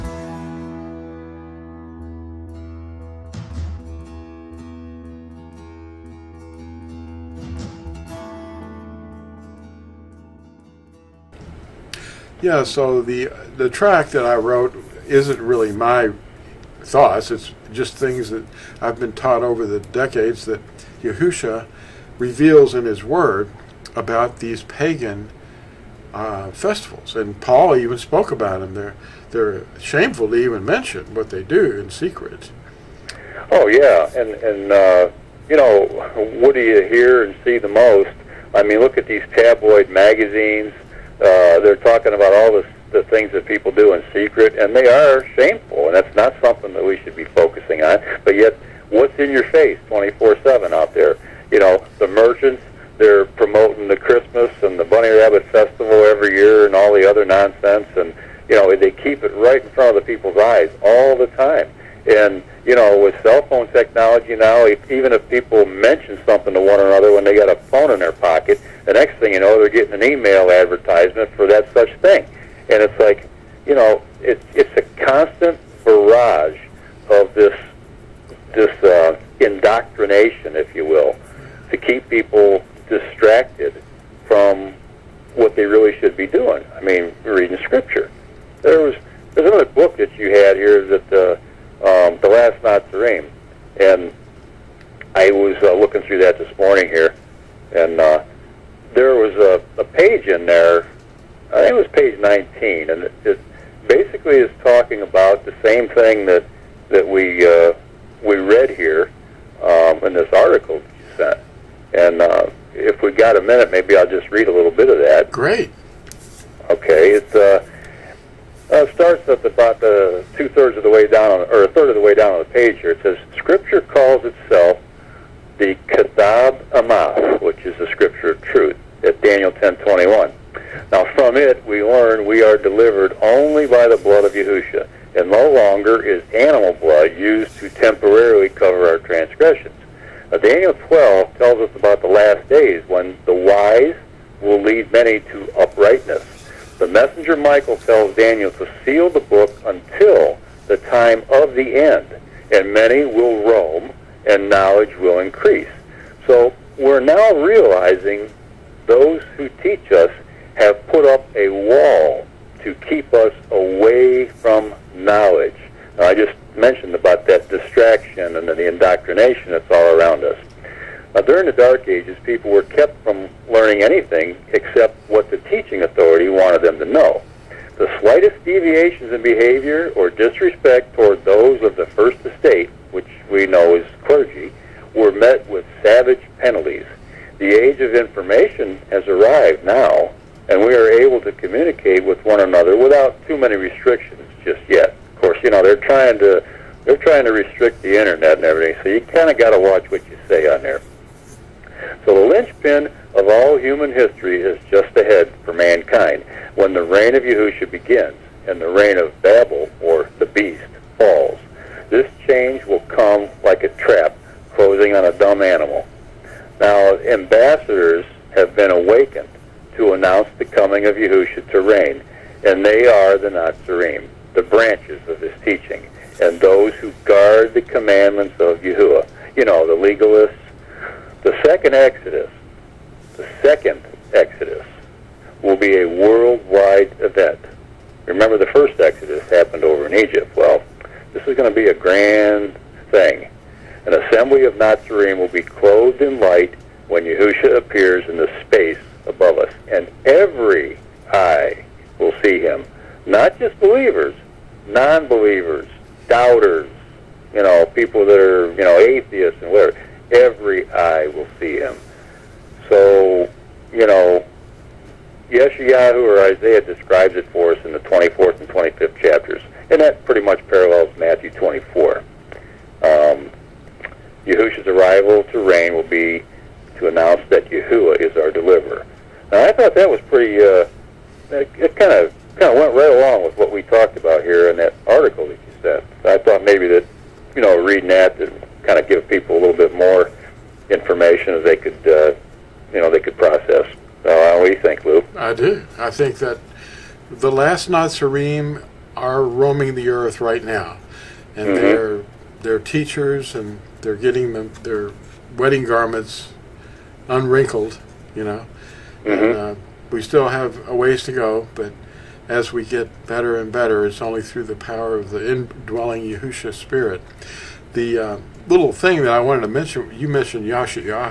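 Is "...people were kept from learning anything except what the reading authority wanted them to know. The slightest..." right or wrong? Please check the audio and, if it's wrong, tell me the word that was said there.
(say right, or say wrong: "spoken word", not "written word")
wrong: "teaching", not "reading".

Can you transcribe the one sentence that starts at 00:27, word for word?
And Paul even spoke about them.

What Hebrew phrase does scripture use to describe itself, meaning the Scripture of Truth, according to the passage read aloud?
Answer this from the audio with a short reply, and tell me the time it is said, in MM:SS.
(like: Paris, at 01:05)
Kathab Amath, at 02:05.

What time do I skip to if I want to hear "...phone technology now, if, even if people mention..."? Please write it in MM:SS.
01:03.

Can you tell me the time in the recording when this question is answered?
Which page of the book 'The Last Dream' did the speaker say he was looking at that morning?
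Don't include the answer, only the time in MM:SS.
01:41.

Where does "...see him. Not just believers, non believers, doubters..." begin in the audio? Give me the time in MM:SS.
04:12.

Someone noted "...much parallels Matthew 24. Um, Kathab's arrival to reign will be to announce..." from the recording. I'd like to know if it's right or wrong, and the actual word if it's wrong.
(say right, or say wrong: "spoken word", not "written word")
wrong: "Yahusha", not "Kathab".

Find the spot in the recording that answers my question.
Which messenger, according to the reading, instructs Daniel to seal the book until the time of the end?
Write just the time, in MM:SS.
02:27.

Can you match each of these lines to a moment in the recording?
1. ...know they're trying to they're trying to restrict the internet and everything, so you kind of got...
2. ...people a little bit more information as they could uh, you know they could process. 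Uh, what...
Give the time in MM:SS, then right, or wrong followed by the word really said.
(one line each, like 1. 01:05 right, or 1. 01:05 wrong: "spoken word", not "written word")
1. 03:15 right
2. 04:49 right.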